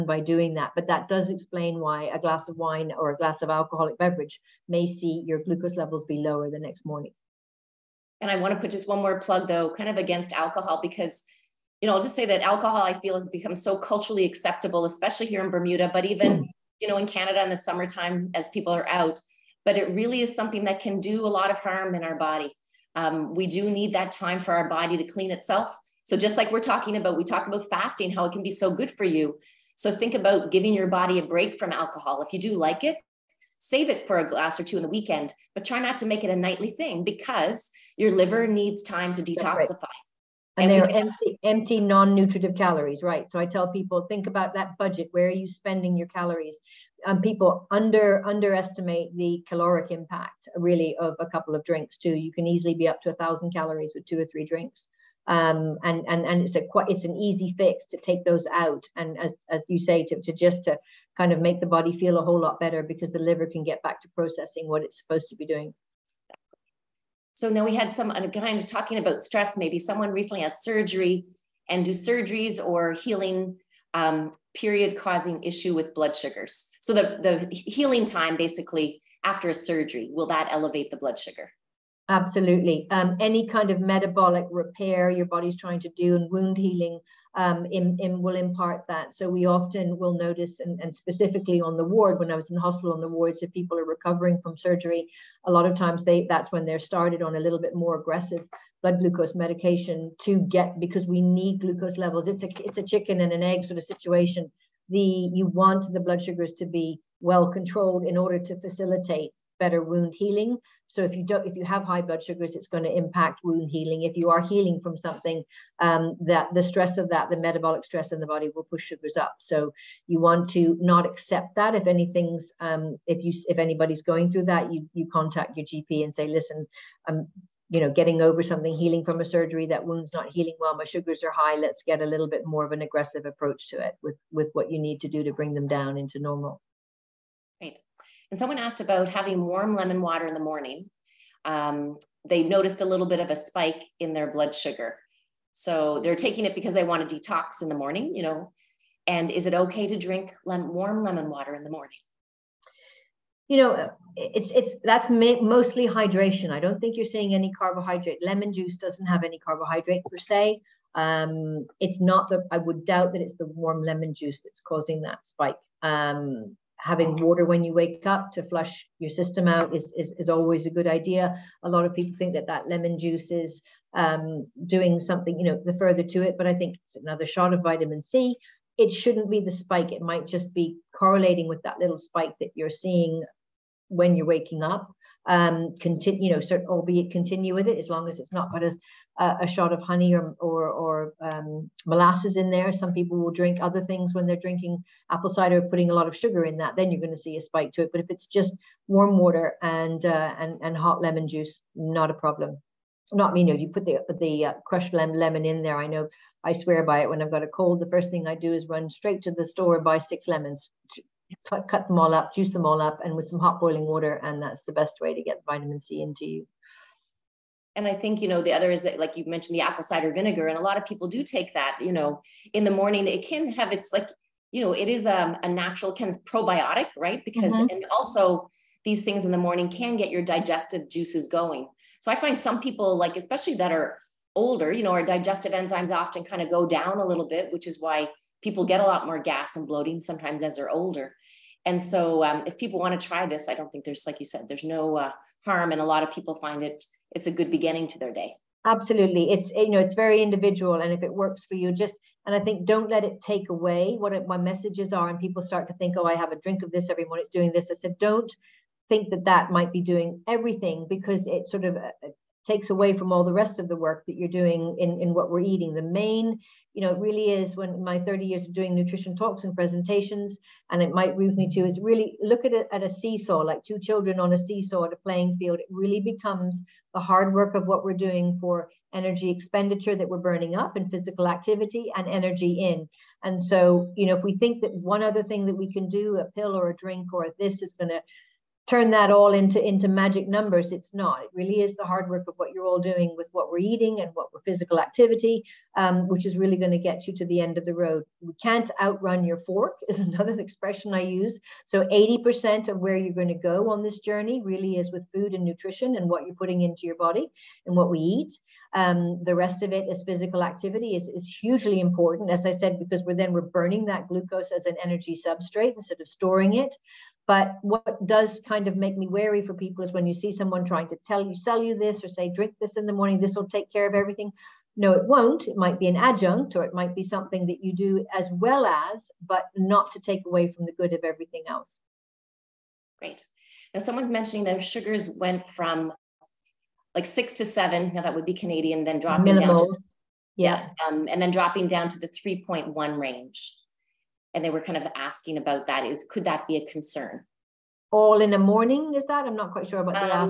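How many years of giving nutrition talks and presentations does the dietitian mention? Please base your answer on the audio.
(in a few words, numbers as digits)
30.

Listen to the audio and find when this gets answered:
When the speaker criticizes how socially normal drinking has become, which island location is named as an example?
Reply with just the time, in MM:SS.
00:15.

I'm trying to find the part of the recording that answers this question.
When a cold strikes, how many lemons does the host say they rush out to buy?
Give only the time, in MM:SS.
03:29.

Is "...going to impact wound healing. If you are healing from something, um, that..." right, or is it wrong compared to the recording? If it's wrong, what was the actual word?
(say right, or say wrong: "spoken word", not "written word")
right.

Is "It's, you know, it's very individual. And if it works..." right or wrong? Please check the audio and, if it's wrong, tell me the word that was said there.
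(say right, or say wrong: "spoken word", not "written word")
right.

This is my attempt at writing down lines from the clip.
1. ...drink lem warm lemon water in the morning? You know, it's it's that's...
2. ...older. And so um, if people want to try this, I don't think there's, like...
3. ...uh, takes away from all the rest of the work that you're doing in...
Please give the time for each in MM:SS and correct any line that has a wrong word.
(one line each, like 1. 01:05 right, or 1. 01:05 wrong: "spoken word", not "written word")
1. 02:29 right
2. 04:00 right
3. 04:21 right.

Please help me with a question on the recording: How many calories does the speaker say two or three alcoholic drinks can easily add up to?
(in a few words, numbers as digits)
1000.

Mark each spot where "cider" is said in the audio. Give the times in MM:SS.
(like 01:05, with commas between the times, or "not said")
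03:15, 03:39.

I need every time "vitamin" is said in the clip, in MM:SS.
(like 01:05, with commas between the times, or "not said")
02:57, 03:35.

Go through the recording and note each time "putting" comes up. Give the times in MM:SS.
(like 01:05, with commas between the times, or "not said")
03:15, 05:06.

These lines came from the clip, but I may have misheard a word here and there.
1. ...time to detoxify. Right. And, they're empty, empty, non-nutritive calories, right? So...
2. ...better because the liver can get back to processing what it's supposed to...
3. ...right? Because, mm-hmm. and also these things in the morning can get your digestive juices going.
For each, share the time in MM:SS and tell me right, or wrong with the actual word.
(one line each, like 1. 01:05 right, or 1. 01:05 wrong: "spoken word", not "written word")
1. 00:38 right
2. 01:02 right
3. 03:46 right.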